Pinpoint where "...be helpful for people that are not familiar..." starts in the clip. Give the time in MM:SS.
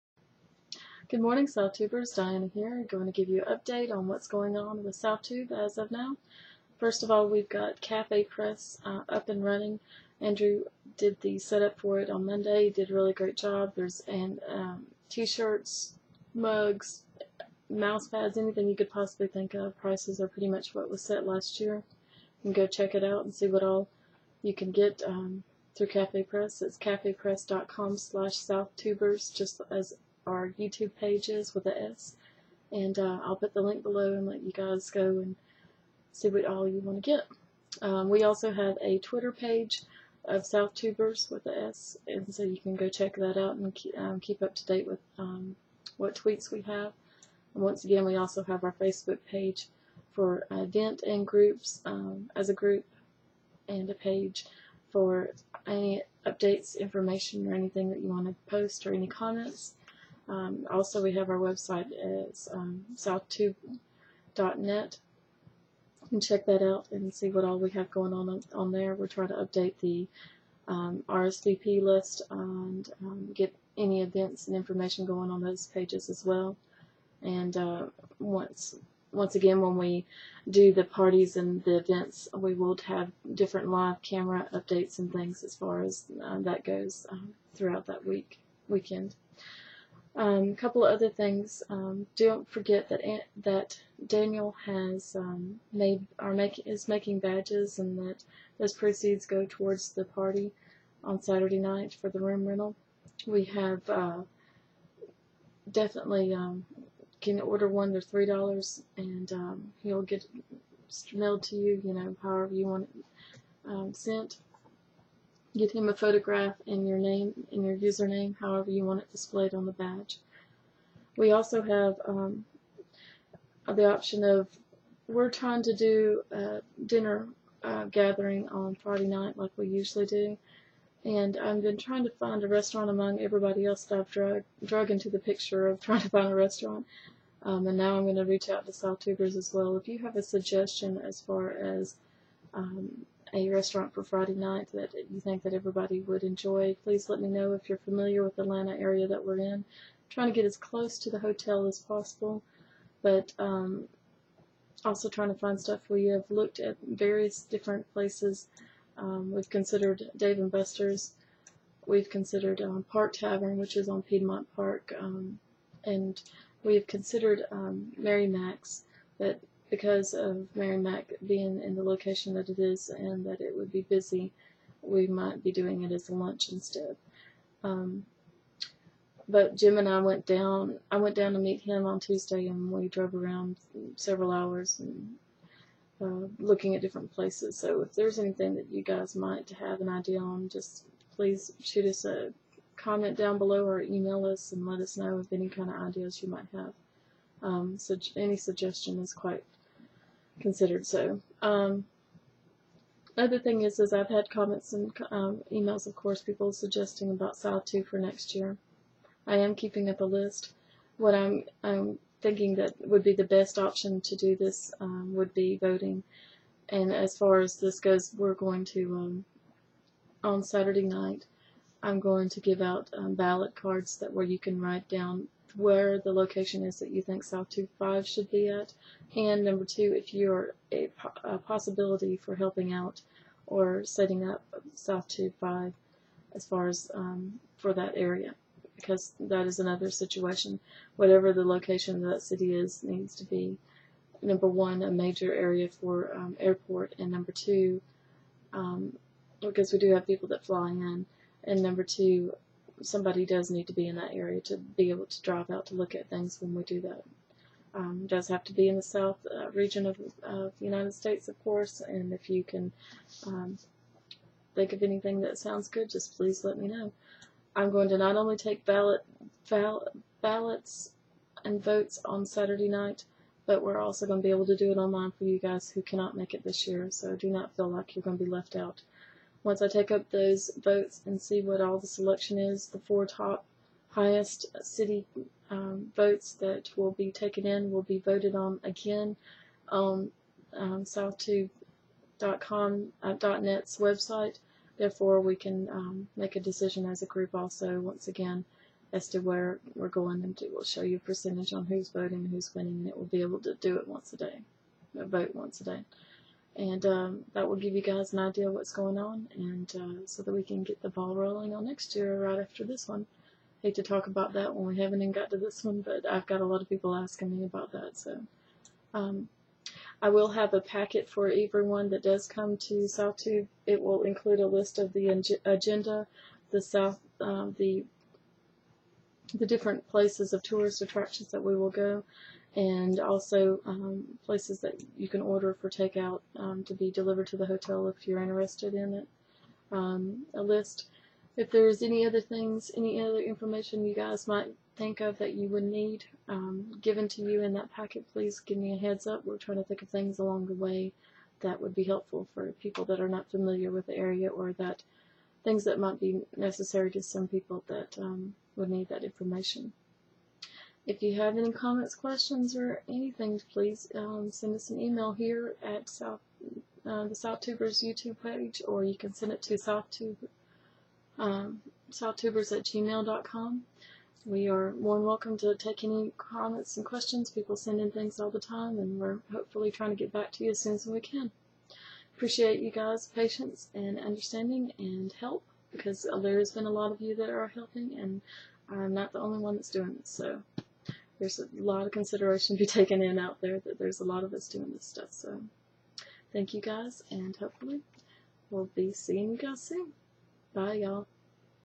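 05:51.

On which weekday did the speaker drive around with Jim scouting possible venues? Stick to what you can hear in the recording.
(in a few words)
Tuesday.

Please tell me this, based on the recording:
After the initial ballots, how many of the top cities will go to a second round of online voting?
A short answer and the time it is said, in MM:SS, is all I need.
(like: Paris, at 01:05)
4, at 04:42.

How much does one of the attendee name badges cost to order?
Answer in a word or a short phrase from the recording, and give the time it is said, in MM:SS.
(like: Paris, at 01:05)
$3, at 01:48.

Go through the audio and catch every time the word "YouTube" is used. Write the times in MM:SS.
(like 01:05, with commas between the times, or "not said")
00:30, 06:07.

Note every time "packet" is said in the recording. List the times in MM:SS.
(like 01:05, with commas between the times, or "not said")
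05:20, 05:47.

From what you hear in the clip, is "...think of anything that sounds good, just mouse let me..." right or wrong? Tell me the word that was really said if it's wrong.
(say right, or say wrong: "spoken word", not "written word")
wrong: "please", not "mouse".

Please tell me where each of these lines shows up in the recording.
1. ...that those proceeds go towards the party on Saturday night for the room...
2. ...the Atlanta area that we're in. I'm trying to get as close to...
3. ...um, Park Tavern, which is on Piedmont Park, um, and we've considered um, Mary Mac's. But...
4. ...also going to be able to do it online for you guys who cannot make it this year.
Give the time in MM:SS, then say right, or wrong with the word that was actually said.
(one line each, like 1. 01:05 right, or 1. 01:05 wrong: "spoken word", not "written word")
1. 01:37 right
2. 02:28 right
3. 02:42 right
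4. 04:33 right.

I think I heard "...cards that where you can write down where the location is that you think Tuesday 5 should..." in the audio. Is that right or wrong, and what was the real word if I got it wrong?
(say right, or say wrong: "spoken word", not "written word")
wrong: "SouthTube", not "Tuesday".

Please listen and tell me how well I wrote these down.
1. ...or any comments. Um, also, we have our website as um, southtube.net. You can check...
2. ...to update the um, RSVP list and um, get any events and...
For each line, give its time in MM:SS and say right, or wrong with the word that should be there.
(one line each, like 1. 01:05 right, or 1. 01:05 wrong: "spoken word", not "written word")
1. 00:58 right
2. 01:09 right.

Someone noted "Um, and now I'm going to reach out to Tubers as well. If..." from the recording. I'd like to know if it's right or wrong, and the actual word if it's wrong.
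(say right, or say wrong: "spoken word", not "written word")
right.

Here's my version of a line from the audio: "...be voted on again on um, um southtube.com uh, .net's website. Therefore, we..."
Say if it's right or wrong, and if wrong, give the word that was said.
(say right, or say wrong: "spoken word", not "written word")
right.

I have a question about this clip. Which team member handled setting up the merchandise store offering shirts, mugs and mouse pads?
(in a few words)
Andrew.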